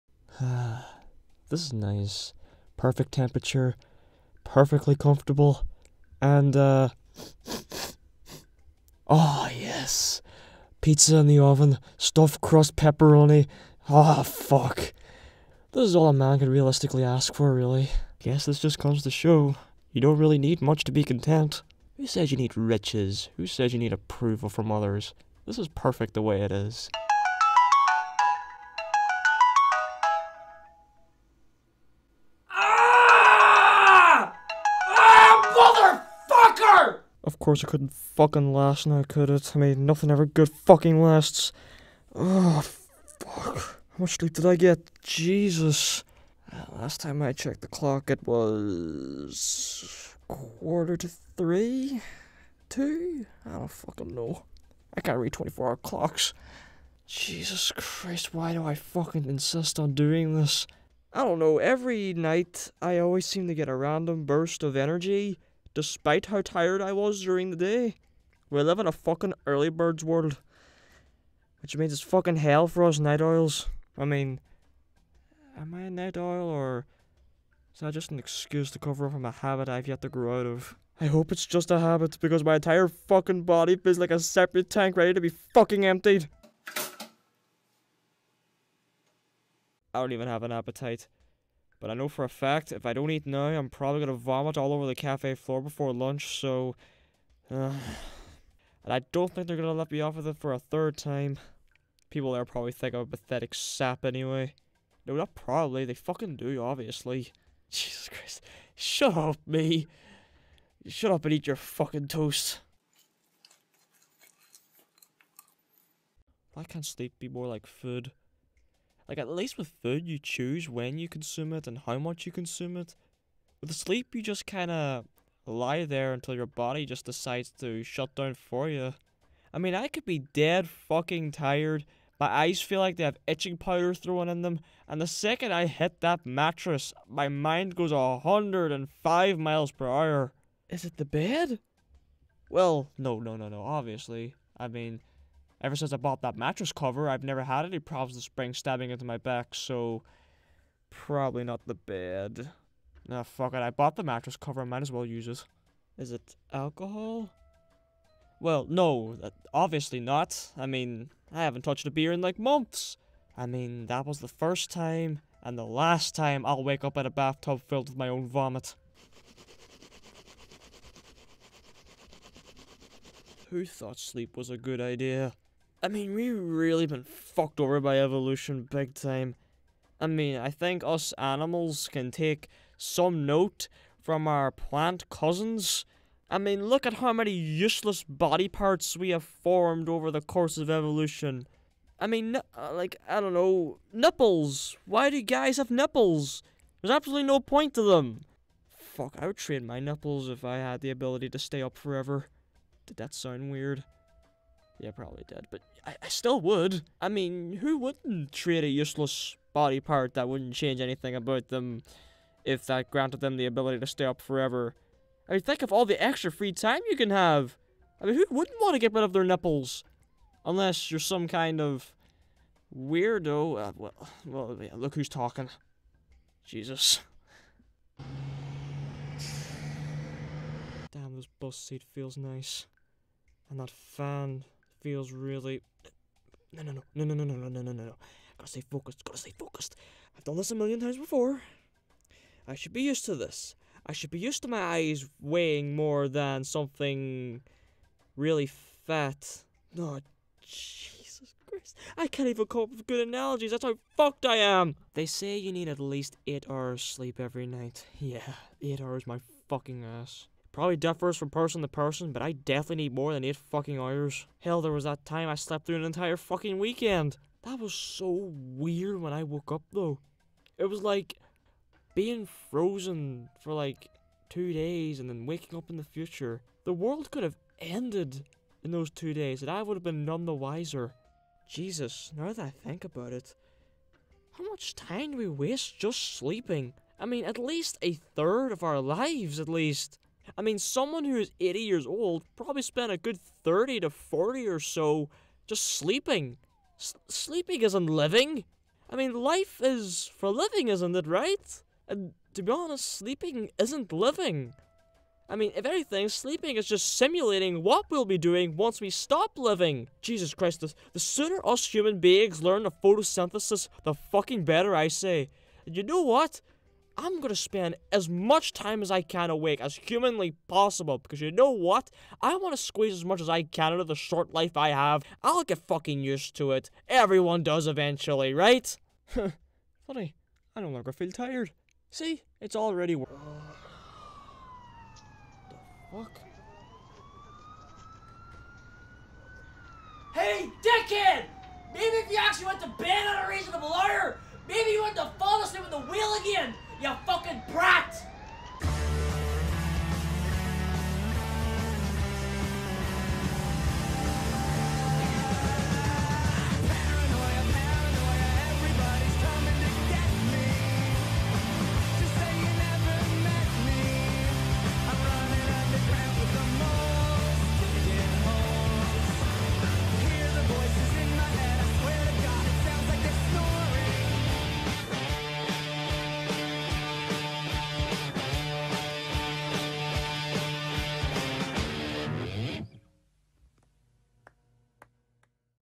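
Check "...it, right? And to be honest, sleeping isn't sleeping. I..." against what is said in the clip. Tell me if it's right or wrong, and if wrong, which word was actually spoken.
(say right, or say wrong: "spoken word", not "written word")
wrong: "living", not "sleeping".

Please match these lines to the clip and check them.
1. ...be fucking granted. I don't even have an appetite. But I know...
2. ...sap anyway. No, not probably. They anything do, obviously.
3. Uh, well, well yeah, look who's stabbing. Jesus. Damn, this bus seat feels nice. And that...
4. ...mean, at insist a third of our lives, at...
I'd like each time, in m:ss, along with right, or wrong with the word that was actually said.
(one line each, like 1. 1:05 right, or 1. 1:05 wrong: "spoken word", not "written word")
1. 1:25 wrong: "emptied", not "granted"
2. 1:43 wrong: "fucking", not "anything"
3. 3:43 wrong: "talking", not "stabbing"
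4. 4:47 wrong: "least", not "insist".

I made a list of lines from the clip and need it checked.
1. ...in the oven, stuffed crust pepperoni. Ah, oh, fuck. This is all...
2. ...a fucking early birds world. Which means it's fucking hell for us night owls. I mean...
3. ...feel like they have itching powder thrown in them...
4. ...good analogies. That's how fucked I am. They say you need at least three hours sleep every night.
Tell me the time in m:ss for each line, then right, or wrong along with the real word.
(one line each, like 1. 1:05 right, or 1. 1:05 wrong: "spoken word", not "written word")
1. 0:11 right
2. 1:08 right
3. 2:12 right
4. 4:12 wrong: "eight", not "three".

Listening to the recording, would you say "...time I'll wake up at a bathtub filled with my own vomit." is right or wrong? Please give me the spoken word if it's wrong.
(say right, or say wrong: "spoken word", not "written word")
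right.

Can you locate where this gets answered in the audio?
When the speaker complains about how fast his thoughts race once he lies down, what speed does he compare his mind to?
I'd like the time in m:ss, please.
2:17.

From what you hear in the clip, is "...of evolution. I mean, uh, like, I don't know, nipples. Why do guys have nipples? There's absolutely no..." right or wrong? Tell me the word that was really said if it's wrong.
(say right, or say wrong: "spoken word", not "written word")
right.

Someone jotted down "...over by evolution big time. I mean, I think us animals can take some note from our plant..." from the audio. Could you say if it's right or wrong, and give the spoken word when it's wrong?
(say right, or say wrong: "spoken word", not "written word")
right.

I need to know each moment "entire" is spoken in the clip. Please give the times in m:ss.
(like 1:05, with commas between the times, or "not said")
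1:22, 4:25.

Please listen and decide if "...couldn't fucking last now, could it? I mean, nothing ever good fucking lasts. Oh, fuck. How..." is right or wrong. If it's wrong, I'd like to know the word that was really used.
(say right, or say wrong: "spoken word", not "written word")
right.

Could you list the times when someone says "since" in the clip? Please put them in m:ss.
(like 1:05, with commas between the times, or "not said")
2:25.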